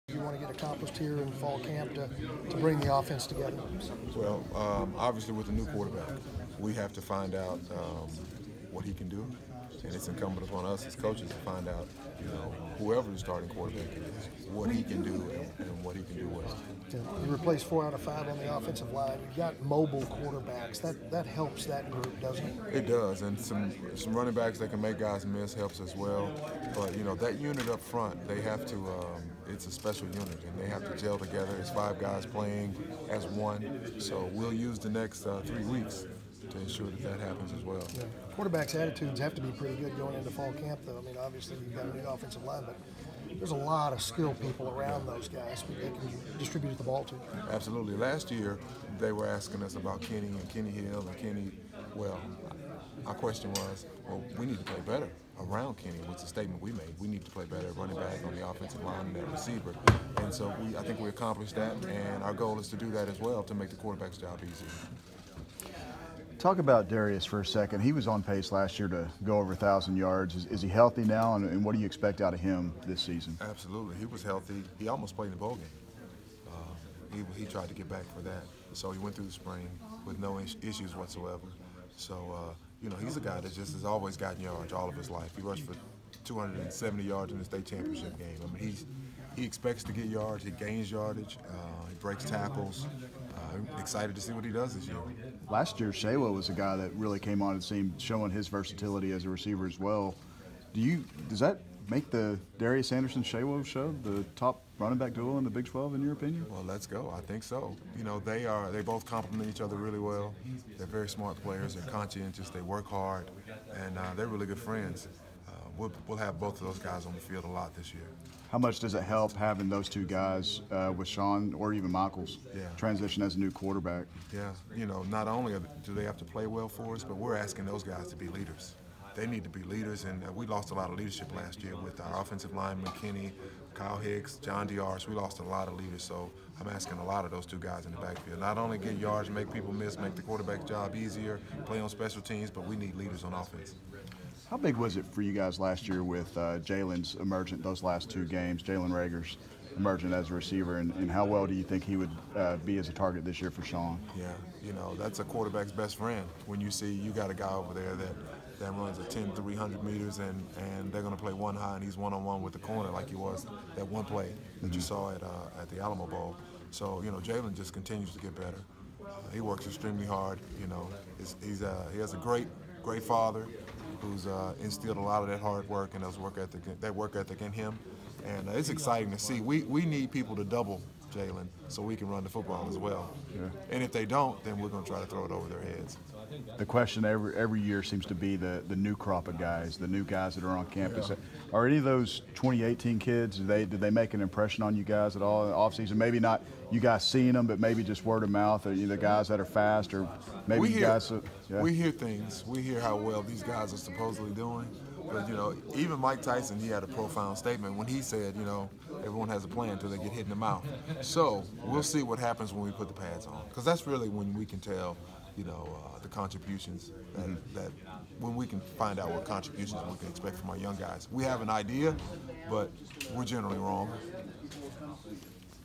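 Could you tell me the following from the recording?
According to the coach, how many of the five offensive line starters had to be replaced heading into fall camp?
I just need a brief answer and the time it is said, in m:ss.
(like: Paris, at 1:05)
4, at 0:17.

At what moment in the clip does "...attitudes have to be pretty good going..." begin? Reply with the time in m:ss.
0:38.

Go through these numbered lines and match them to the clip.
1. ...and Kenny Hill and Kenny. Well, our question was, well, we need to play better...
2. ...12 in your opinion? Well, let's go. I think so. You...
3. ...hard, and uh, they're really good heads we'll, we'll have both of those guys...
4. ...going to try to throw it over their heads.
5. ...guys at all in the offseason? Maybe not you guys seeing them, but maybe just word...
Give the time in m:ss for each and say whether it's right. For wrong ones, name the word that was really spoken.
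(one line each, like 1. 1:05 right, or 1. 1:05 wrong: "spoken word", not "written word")
1. 0:50 right
2. 1:45 right
3. 1:52 wrong: "friends", not "heads"
4. 3:04 right
5. 3:14 right.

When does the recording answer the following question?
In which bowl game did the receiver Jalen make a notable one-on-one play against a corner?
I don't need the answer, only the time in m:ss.
2:45.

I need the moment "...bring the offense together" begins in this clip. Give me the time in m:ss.
0:02.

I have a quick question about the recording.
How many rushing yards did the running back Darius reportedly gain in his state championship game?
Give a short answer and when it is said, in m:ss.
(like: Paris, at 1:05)
270, at 1:26.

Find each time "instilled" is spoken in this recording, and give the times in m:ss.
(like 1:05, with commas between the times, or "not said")
2:54.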